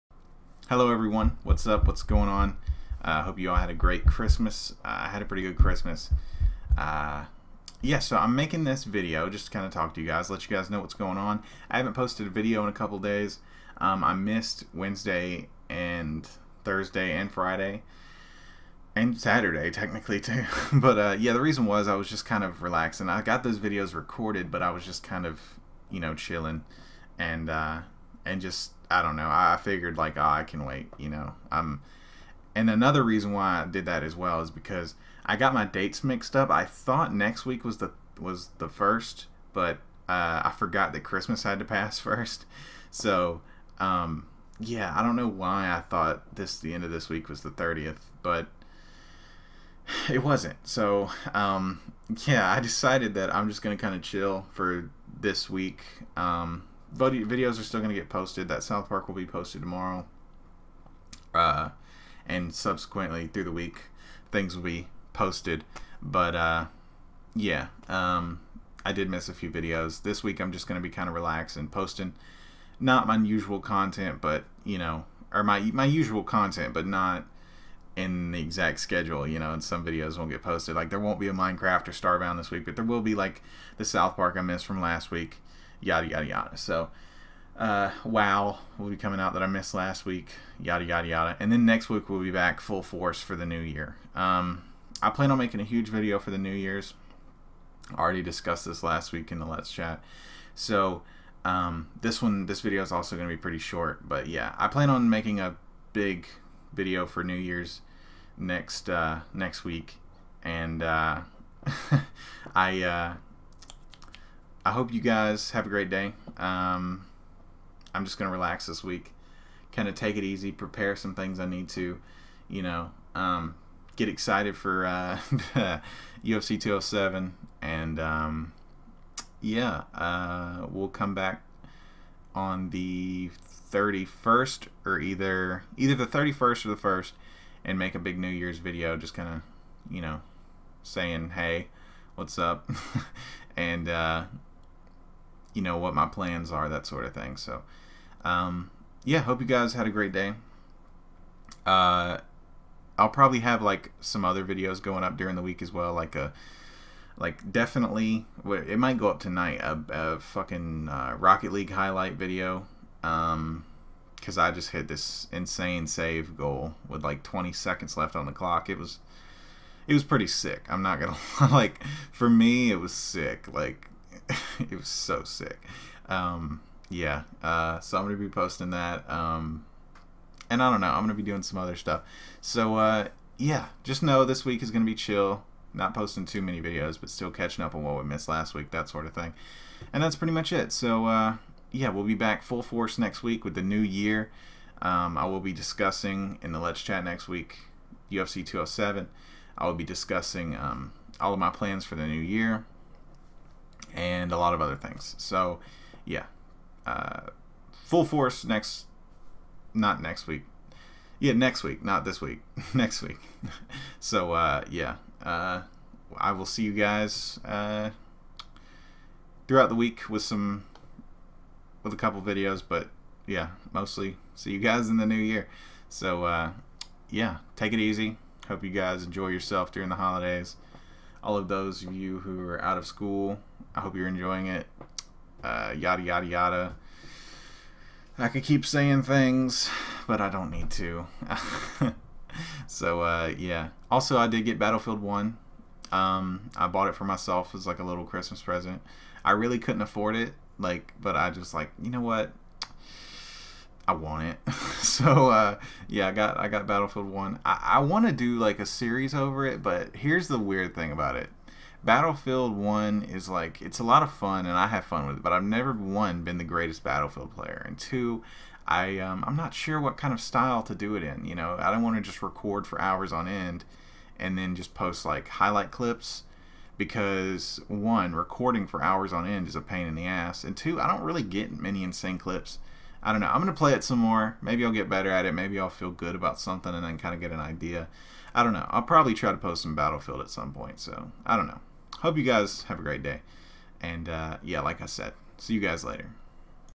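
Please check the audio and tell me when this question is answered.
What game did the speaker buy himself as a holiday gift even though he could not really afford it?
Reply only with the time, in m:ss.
4:04.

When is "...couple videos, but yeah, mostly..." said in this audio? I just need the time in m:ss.
3:41.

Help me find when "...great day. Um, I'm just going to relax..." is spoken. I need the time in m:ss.
1:55.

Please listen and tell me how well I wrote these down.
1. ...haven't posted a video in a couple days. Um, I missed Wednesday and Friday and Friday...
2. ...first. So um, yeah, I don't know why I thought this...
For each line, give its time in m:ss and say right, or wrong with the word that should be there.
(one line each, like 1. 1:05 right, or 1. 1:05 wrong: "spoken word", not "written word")
1. 0:11 wrong: "Thursday", not "Friday"
2. 0:41 right.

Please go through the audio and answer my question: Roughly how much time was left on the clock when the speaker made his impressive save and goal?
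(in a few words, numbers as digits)
20 seconds.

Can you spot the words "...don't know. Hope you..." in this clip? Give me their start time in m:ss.
4:51.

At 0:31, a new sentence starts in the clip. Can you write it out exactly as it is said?
I'm and another reason why I did that as well is because I got my dates mixed up.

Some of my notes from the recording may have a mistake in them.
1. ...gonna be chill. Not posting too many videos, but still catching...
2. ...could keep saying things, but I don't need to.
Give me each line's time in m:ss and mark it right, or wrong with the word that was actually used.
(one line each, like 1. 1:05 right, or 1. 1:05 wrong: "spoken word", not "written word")
1. 3:04 right
2. 3:58 right.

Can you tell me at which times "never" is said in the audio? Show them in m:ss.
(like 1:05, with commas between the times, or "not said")
4:25.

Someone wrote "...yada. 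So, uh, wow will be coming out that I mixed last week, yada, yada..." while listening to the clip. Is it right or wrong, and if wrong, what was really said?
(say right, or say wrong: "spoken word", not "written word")
wrong: "missed", not "mixed".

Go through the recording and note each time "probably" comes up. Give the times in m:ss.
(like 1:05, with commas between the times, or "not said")
2:33, 4:48.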